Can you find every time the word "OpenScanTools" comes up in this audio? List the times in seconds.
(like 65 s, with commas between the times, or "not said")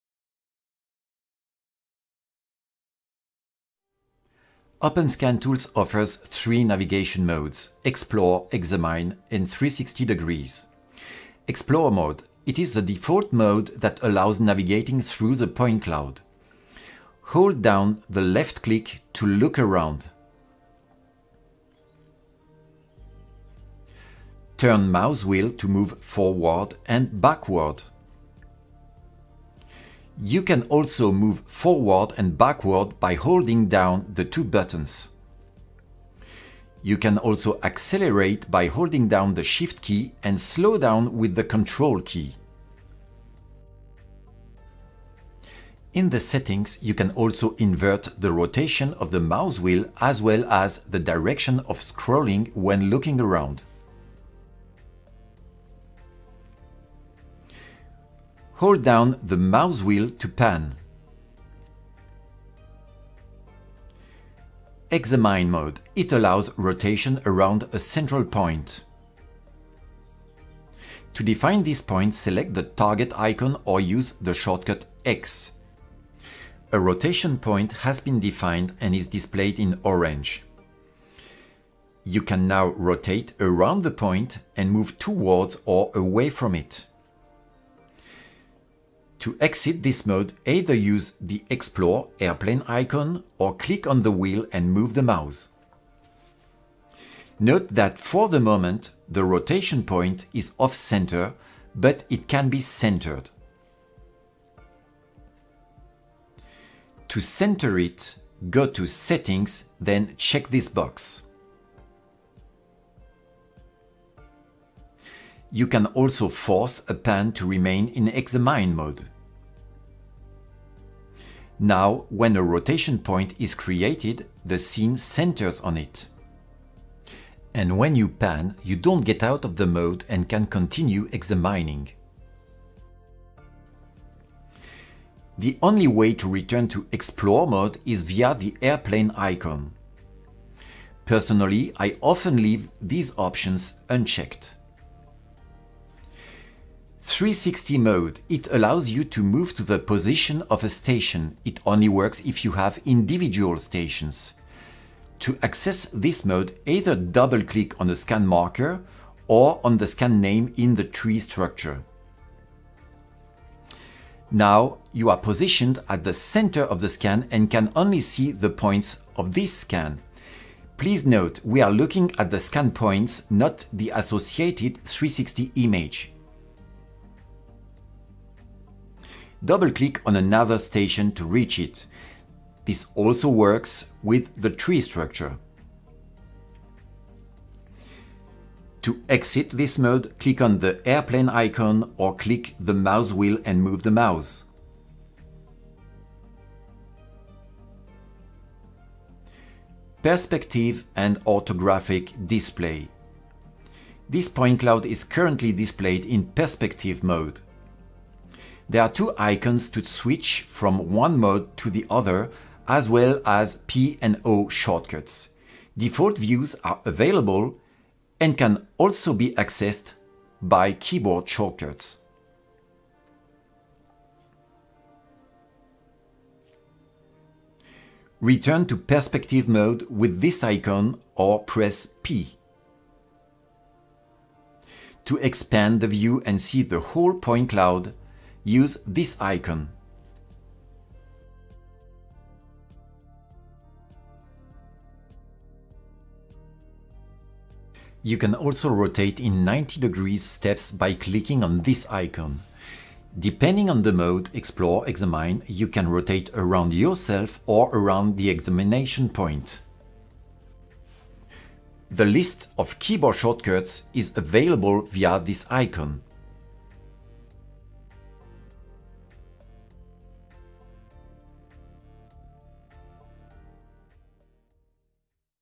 4 s.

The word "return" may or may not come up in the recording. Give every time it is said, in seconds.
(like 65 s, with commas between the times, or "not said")
136 s, 228 s.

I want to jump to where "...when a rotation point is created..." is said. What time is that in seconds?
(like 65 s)
122 s.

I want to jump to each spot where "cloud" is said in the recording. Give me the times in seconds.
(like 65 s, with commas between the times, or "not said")
15 s, 204 s, 237 s.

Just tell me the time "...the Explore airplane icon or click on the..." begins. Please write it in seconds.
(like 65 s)
91 s.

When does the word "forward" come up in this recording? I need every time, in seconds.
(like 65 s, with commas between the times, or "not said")
26 s, 31 s.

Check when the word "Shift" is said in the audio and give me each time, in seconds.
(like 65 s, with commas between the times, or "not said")
39 s.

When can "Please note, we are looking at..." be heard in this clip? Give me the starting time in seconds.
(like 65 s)
170 s.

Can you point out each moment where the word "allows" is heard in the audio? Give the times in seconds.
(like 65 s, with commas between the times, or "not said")
14 s, 66 s, 148 s.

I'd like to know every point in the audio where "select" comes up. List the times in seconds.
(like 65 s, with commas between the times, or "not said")
72 s.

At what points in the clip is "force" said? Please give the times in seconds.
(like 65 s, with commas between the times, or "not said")
116 s.